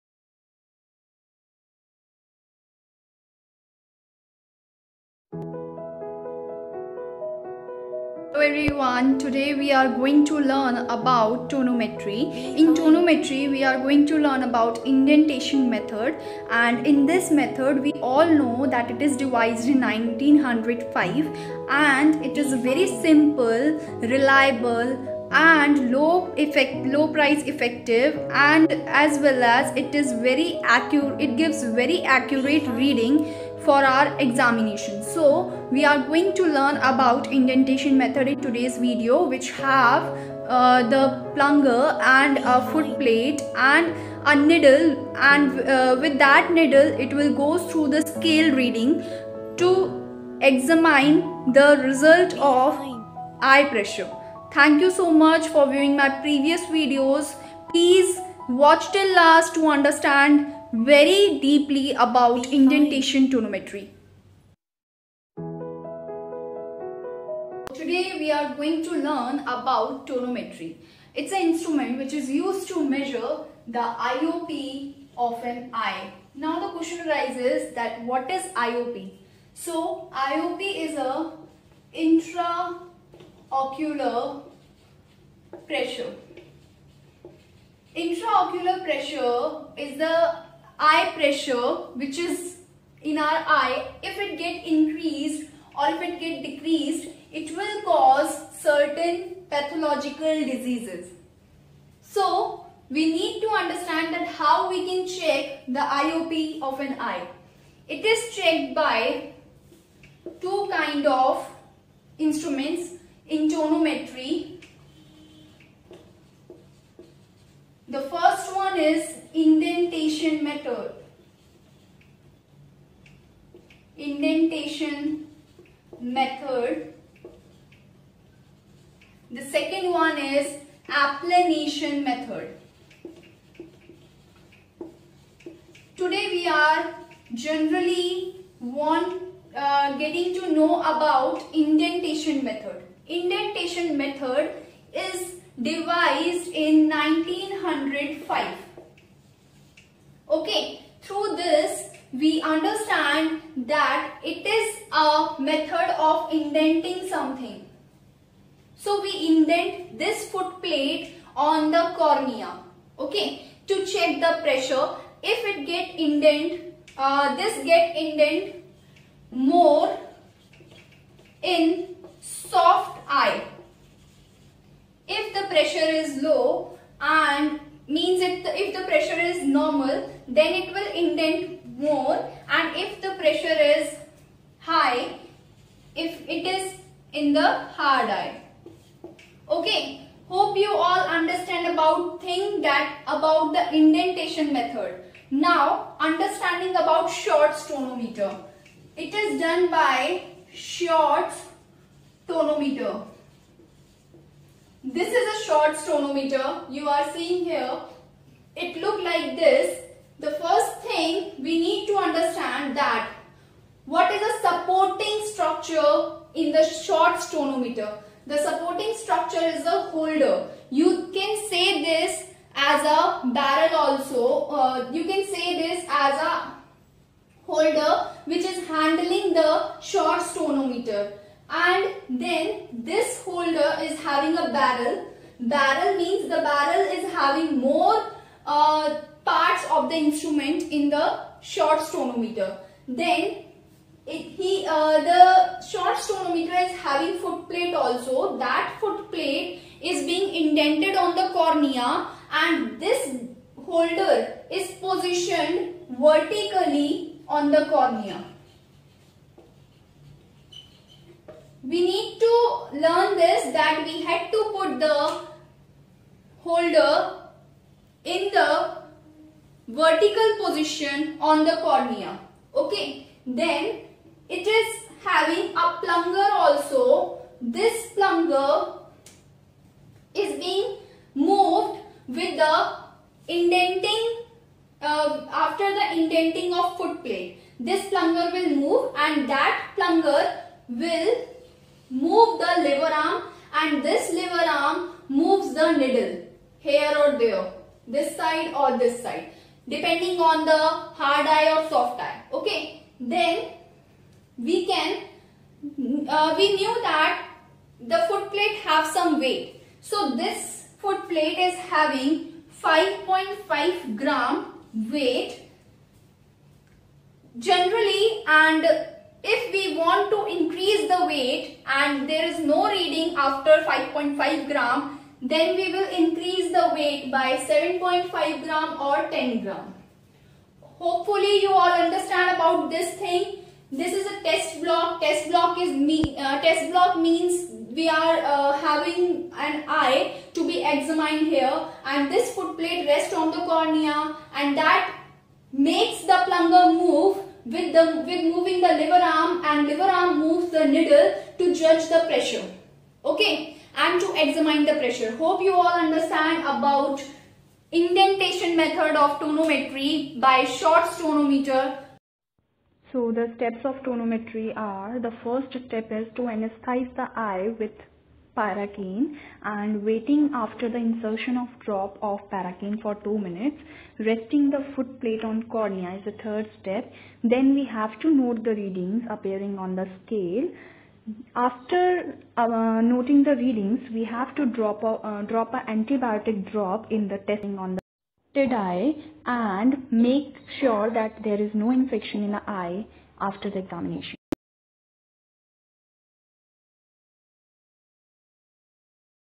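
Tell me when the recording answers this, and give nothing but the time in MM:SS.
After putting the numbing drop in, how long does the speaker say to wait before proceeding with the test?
06:12.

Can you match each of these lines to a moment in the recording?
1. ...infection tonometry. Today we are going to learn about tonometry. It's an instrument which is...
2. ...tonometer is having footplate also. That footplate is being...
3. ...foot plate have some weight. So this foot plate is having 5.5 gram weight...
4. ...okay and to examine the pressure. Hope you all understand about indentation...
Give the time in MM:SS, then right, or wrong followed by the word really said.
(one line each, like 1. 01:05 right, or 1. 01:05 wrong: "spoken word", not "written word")
1. 01:02 wrong: "indentation", not "infection"
2. 04:06 right
3. 05:08 right
4. 05:53 right.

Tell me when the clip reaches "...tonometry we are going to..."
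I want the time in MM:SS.
00:12.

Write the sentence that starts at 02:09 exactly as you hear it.
The second one is applanation method.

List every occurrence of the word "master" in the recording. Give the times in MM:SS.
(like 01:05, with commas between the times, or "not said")
not said.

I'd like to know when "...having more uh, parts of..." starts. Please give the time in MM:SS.
03:57.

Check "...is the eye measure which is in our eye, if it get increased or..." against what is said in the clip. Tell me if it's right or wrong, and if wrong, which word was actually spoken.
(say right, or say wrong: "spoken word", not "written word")
wrong: "pressure", not "measure".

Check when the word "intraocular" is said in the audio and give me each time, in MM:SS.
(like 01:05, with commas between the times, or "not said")
01:21, 01:27.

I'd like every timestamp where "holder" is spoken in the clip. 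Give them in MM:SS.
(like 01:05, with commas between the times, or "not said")
03:39, 03:47, 03:53, 04:13, 04:26.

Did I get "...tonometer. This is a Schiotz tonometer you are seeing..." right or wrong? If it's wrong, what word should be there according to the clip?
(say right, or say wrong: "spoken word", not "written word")
right.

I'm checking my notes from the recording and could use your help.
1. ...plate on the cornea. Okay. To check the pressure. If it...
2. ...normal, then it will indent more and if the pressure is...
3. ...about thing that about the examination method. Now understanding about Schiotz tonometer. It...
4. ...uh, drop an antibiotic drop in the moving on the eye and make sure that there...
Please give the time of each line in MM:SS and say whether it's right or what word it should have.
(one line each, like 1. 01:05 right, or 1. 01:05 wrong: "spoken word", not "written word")
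1. 02:40 right
2. 02:59 right
3. 03:11 wrong: "indentation", not "examination"
4. 06:25 wrong: "testing", not "moving".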